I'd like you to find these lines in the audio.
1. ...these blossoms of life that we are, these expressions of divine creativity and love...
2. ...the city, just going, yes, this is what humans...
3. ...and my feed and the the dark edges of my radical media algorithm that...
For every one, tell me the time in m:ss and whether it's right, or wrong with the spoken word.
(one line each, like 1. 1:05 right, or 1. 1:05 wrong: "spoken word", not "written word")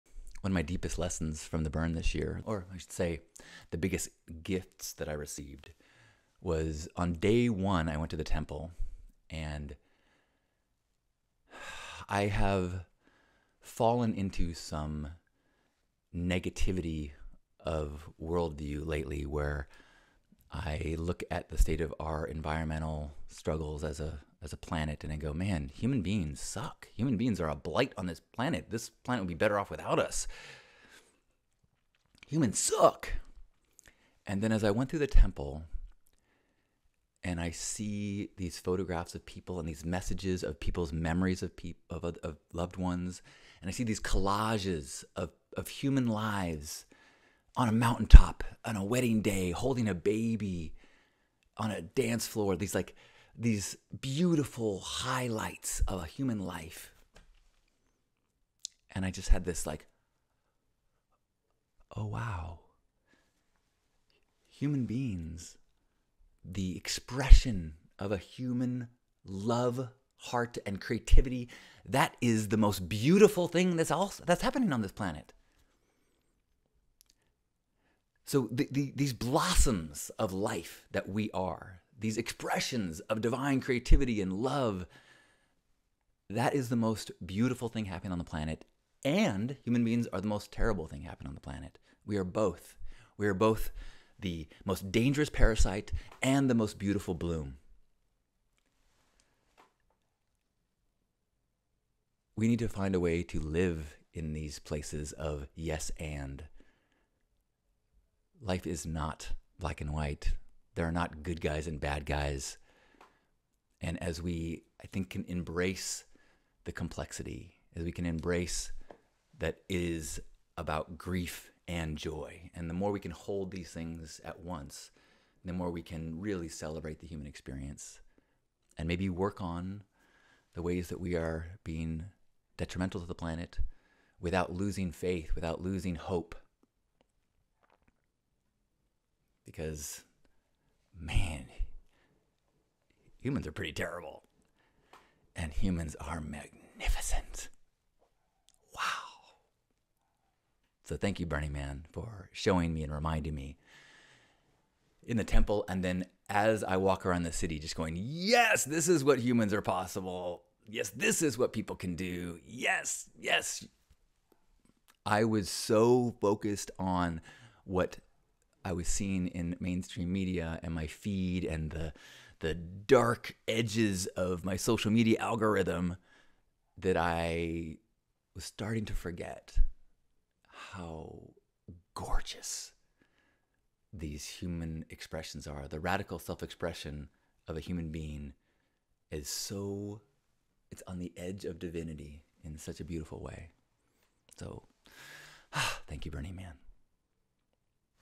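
1. 1:18 right
2. 2:37 right
3. 2:50 wrong: "social", not "radical".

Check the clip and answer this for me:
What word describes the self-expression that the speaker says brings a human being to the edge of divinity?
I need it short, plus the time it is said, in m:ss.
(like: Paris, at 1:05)
Radical, at 3:05.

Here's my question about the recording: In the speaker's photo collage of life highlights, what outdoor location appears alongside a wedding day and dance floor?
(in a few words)
A mountaintop.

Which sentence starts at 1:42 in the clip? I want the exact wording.
We need to find a way to live in these places of yes and life is not black and white.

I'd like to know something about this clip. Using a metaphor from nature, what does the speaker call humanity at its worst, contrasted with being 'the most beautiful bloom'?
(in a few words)
The most dangerous parasite.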